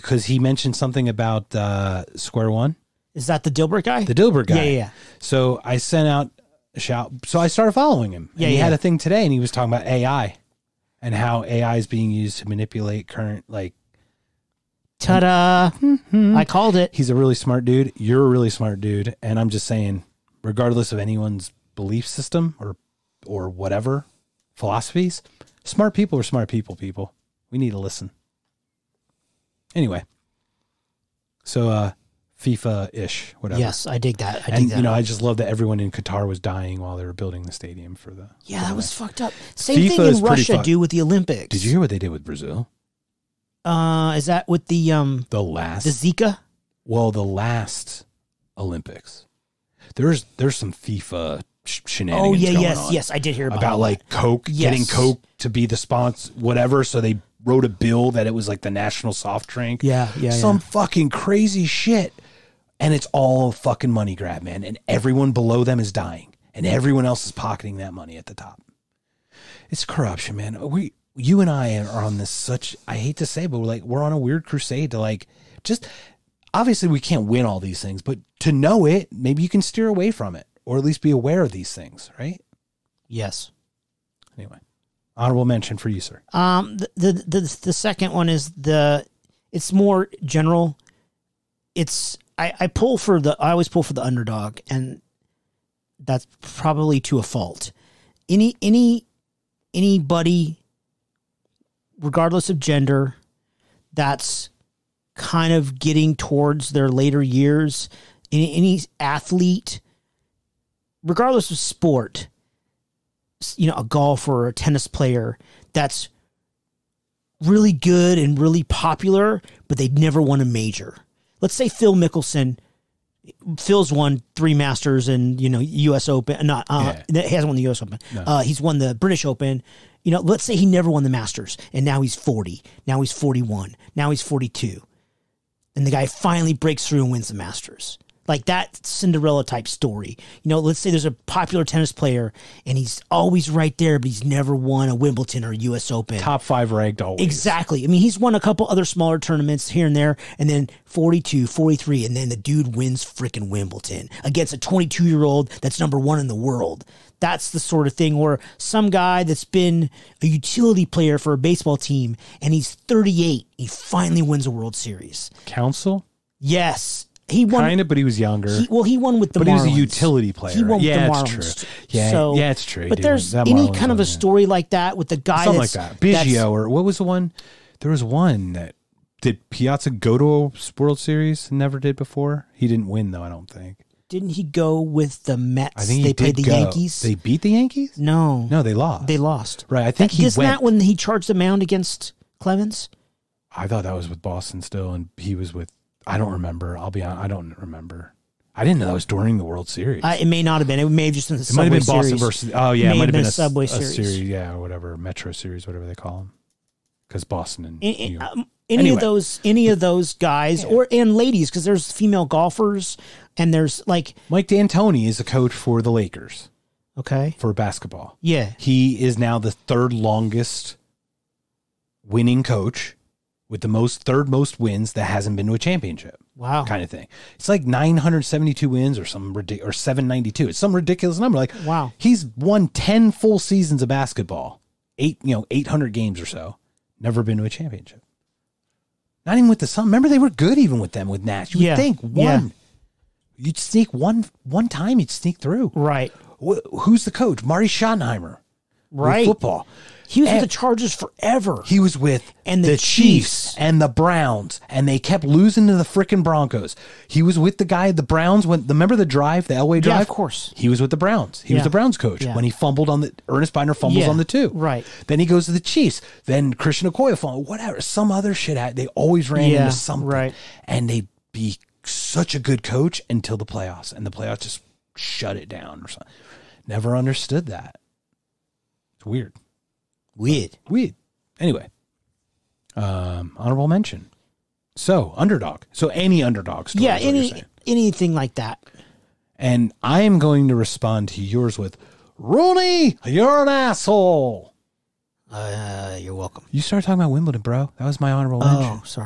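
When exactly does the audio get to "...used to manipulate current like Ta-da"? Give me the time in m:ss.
0:12.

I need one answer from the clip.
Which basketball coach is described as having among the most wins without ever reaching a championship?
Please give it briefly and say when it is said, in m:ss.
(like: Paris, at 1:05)
Mike D'Antoni, at 3:34.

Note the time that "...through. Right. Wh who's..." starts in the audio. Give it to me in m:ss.
4:05.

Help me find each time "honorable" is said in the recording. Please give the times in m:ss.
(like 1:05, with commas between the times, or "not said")
1:25, 4:43, 4:58.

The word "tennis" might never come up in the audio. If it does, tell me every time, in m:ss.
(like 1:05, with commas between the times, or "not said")
1:54, 2:21.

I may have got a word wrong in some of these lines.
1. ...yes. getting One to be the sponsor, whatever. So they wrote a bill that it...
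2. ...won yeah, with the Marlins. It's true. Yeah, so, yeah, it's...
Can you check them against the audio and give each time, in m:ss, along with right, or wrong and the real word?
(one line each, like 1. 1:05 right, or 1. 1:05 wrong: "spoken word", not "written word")
1. 0:54 wrong: "Coke", not "One"
2. 2:50 right.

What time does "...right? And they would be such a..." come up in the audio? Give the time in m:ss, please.
4:30.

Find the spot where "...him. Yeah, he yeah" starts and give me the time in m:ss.
0:08.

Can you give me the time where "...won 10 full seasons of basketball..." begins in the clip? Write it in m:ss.
3:52.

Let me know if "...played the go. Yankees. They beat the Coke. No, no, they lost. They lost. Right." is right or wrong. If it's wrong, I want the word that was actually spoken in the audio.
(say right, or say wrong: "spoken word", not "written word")
wrong: "Yankees", not "Coke".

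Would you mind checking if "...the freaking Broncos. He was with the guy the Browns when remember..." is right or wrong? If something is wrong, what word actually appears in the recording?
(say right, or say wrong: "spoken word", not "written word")
right.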